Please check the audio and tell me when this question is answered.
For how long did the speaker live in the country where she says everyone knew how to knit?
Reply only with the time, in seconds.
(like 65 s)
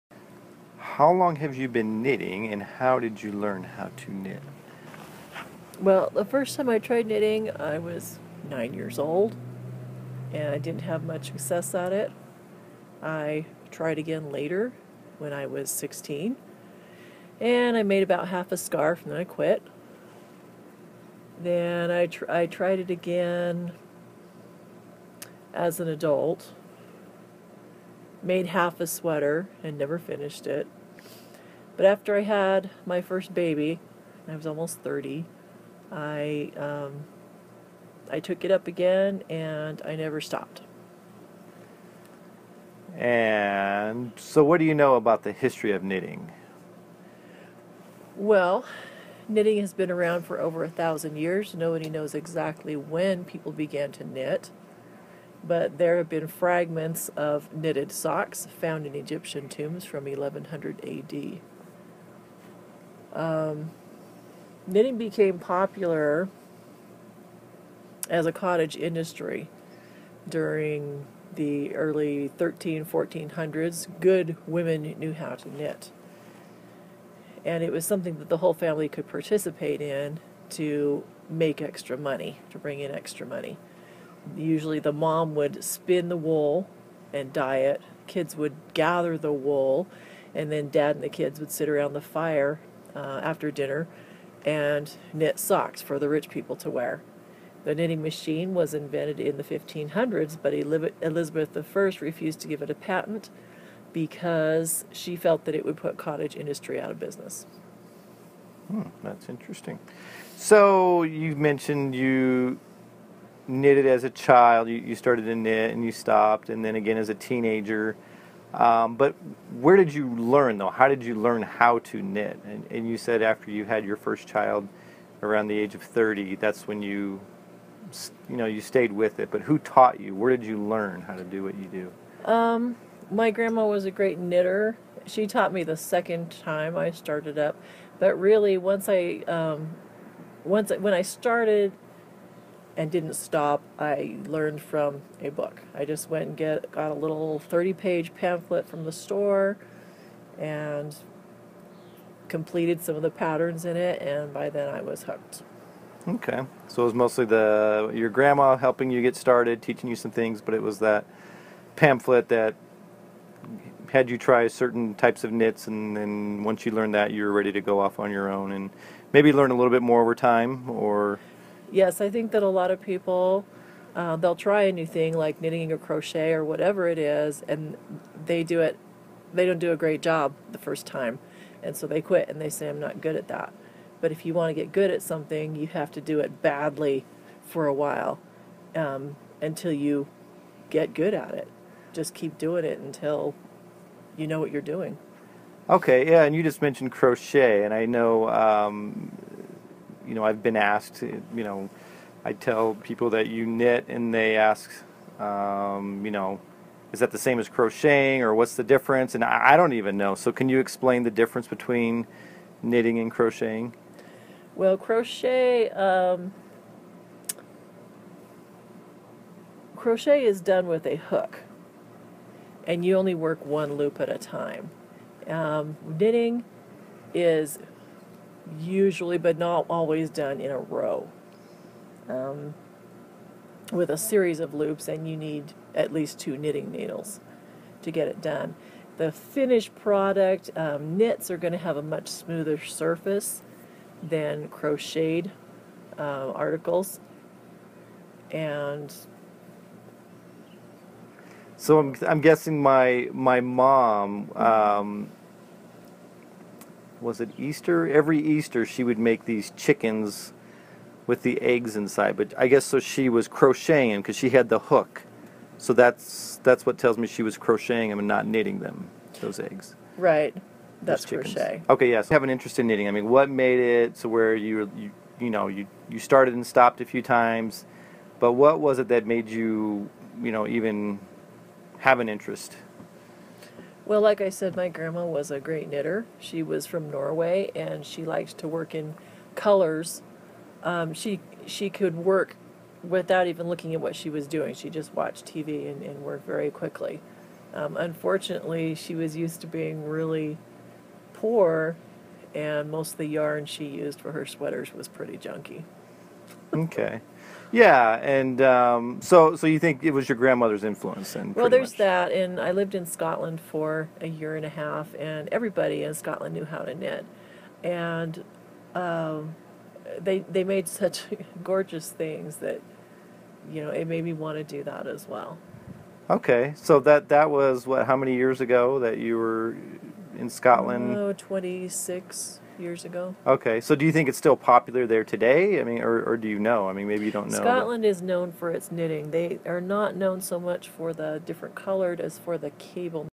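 313 s.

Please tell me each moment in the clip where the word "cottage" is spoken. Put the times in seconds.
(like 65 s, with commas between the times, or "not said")
68 s, 105 s.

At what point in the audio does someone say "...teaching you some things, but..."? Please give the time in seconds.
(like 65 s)
159 s.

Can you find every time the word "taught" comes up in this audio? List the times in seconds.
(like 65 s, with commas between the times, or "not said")
129 s, 135 s.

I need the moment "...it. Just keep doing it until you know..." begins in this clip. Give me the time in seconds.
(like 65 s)
191 s.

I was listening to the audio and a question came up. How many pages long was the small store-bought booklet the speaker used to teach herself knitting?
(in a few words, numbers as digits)
30.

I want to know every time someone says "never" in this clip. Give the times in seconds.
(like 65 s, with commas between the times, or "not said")
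29 s, 39 s.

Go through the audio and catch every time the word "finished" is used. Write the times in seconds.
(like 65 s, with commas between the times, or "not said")
29 s, 239 s.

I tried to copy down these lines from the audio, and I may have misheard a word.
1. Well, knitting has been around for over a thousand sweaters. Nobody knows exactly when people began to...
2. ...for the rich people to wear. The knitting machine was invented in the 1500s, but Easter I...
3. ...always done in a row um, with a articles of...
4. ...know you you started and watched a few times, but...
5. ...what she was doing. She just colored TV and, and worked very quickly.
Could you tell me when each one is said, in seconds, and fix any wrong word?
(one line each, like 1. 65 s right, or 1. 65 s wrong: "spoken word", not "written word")
1. 48 s wrong: "years", not "sweaters"
2. 95 s wrong: "Elizabeth", not "Easter"
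3. 229 s wrong: "series", not "articles"
4. 275 s wrong: "stopped", not "watched"
5. 293 s wrong: "watched", not "colored".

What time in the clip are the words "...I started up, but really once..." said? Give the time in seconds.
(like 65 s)
136 s.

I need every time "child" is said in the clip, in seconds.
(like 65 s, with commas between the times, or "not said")
114 s, 124 s.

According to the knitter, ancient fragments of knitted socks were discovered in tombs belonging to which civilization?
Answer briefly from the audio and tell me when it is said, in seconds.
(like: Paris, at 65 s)
Egyptian, at 58 s.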